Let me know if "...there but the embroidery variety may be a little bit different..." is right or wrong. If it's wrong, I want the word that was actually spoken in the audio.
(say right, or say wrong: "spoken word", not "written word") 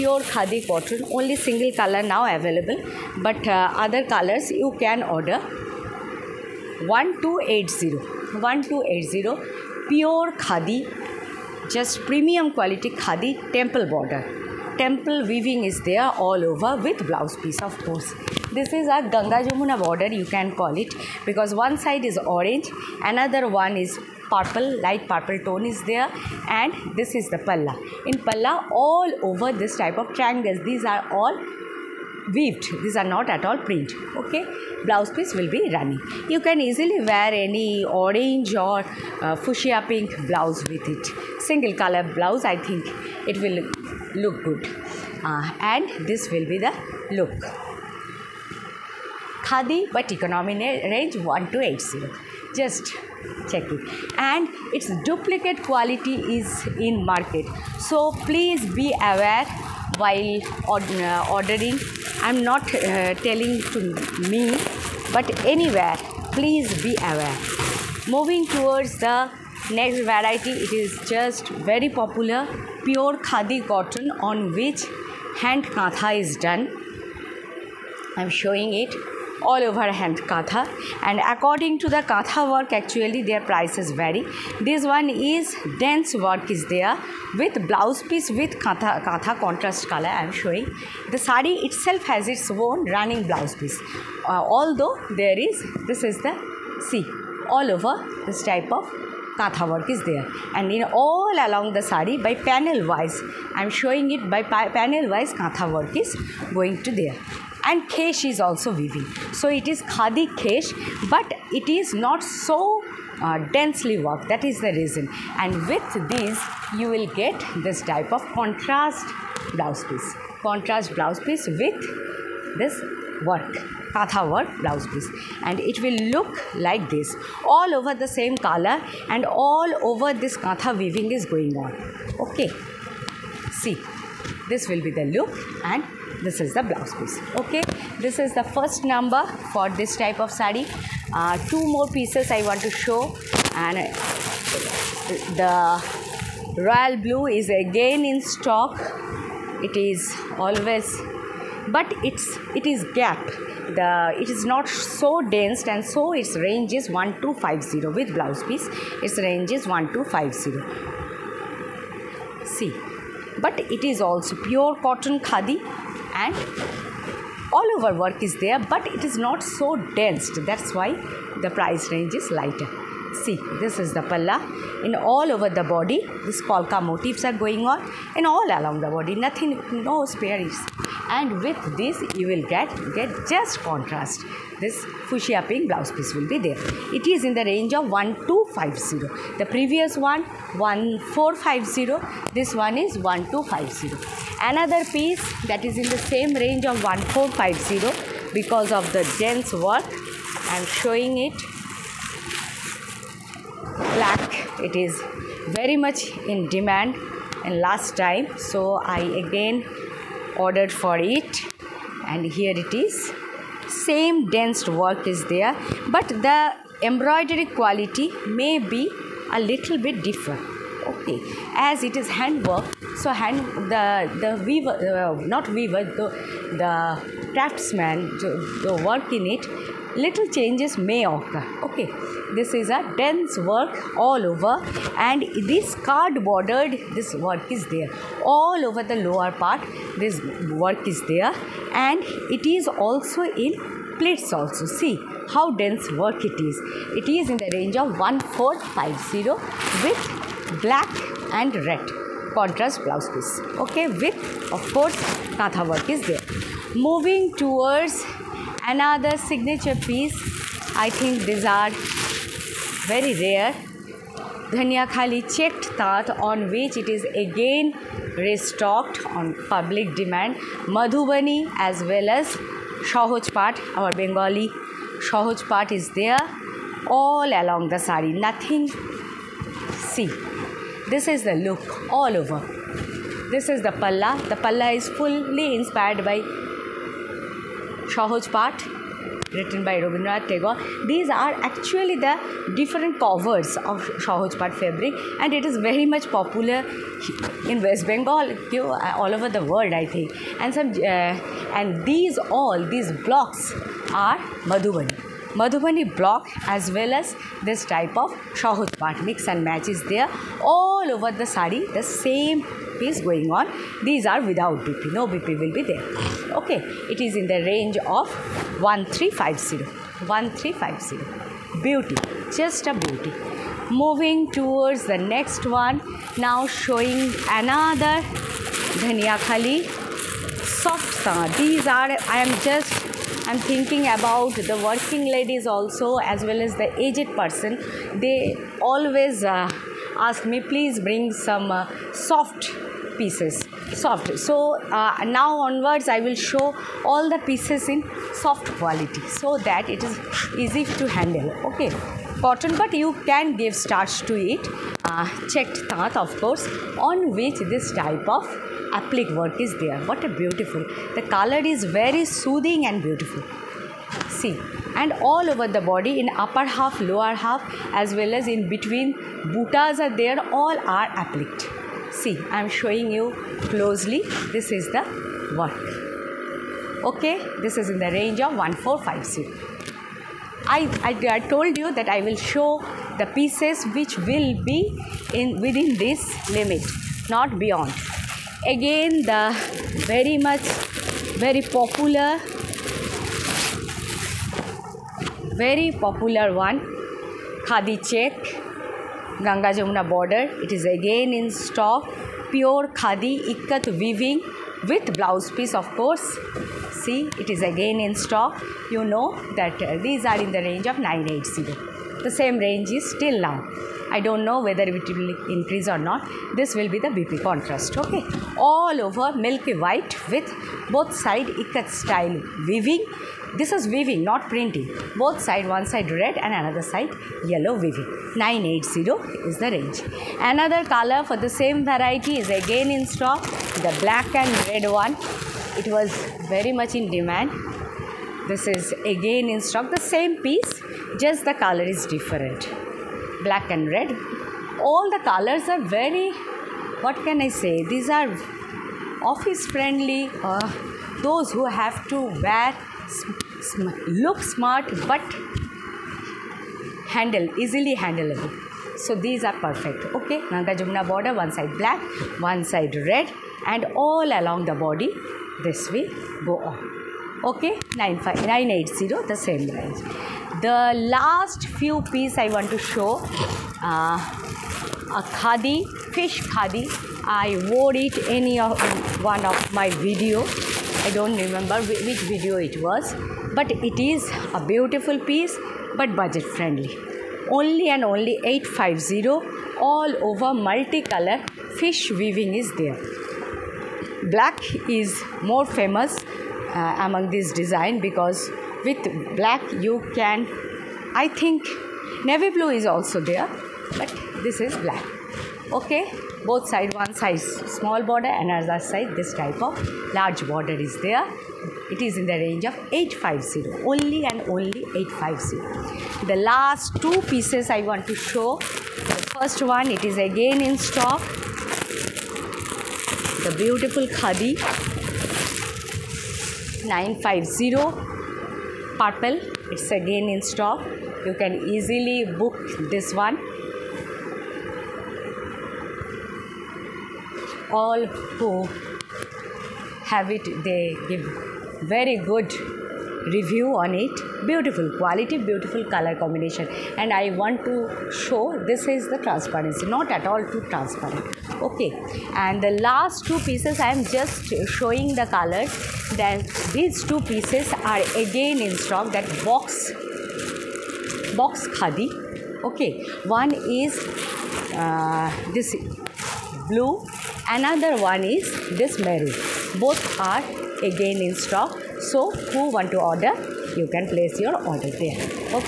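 wrong: "quality", not "variety".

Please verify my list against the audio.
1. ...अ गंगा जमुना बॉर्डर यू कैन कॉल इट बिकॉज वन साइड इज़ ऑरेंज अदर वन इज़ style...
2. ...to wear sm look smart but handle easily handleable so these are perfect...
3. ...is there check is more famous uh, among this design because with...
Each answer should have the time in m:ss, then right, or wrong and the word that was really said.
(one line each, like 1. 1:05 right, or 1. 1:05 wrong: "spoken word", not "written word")
1. 0:18 wrong: "purple", not "style"
2. 7:31 right
3. 8:12 wrong: "black", not "check".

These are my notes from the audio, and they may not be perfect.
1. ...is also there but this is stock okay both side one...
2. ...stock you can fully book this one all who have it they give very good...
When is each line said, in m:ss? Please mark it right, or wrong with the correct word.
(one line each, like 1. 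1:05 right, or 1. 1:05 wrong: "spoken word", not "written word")
1. 8:22 wrong: "black", not "stock"
2. 8:50 wrong: "easily", not "fully".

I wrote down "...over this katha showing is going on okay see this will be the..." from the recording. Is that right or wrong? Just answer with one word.
wrong.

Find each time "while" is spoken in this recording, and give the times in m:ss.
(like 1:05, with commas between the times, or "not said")
1:00.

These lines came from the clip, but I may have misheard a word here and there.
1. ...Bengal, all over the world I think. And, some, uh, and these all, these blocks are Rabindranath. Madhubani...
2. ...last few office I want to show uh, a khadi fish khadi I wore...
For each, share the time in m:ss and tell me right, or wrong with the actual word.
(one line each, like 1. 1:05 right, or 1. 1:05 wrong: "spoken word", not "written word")
1. 4:57 wrong: "Madhubani", not "Rabindranath"
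2. 7:50 wrong: "piece", not "office".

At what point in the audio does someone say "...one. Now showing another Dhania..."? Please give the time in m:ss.
5:25.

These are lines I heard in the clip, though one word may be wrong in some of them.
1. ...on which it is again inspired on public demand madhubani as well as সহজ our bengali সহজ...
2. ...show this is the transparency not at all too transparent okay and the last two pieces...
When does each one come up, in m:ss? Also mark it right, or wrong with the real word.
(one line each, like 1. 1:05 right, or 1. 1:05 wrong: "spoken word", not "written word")
1. 4:26 wrong: "restocked", not "inspired"
2. 9:07 right.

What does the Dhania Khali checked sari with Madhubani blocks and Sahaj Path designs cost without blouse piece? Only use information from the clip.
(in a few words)
1350.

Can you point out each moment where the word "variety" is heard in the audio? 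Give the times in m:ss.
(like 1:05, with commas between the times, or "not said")
1:10, 7:11.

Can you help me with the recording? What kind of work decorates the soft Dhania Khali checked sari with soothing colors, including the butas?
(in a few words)
Applique.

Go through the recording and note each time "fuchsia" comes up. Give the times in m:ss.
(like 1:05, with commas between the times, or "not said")
0:39, 3:05.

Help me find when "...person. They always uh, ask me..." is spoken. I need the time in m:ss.
5:37.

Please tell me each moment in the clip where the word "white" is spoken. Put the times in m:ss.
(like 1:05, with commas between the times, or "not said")
6:59.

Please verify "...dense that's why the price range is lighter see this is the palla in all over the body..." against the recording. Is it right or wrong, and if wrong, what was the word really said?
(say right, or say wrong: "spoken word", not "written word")
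right.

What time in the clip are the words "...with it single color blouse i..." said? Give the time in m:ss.
0:40.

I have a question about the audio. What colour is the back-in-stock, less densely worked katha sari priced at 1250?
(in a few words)
Royal blue.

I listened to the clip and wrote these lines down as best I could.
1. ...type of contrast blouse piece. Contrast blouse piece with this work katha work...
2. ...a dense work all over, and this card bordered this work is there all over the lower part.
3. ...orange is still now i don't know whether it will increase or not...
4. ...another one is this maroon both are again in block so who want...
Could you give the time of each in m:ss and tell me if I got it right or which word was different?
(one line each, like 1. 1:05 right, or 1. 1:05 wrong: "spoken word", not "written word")
1. 1:57 right
2. 3:52 right
3. 6:52 wrong: "range", not "orange"
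4. 9:27 wrong: "stock", not "block".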